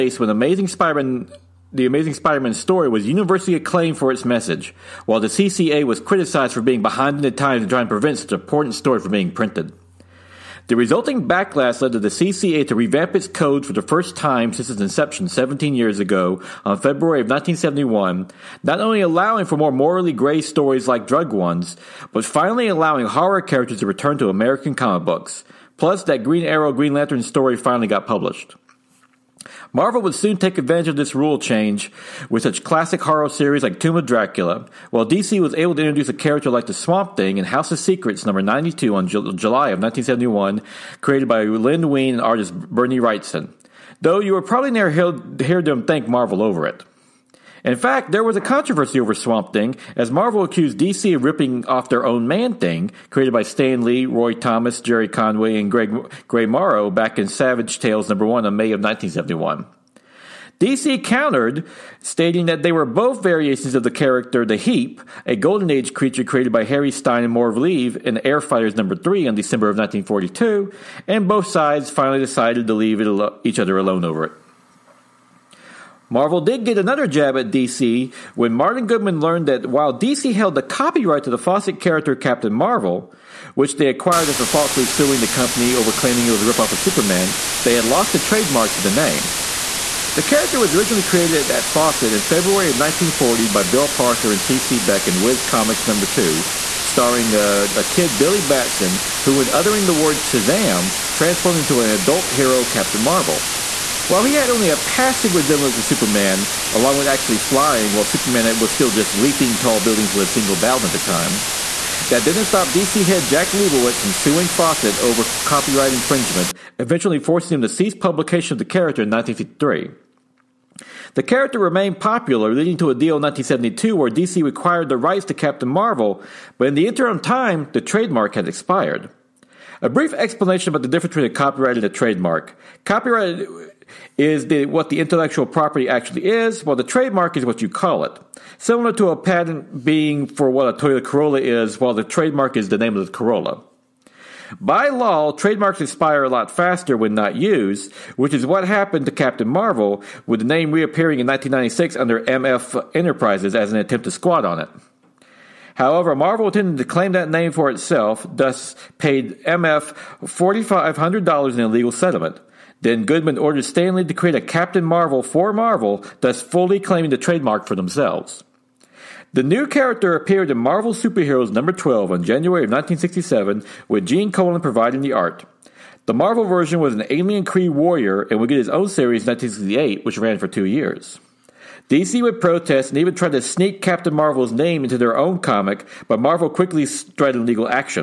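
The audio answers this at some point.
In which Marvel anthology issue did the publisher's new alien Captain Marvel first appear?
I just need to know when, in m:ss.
2:50.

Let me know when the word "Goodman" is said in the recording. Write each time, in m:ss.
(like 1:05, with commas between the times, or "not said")
1:18, 2:43.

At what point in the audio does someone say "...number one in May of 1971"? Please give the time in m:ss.
0:58.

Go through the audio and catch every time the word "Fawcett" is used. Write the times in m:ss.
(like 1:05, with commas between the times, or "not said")
1:21, 1:31, 1:54.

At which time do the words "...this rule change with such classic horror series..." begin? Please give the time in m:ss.
0:30.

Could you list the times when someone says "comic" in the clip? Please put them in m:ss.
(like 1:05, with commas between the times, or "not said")
0:24, 1:35, 3:05.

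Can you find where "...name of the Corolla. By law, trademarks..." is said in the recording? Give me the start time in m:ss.
2:22.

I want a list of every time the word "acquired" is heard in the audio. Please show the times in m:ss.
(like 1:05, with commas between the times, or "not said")
1:23, 2:04.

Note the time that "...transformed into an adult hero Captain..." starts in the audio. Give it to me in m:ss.
1:41.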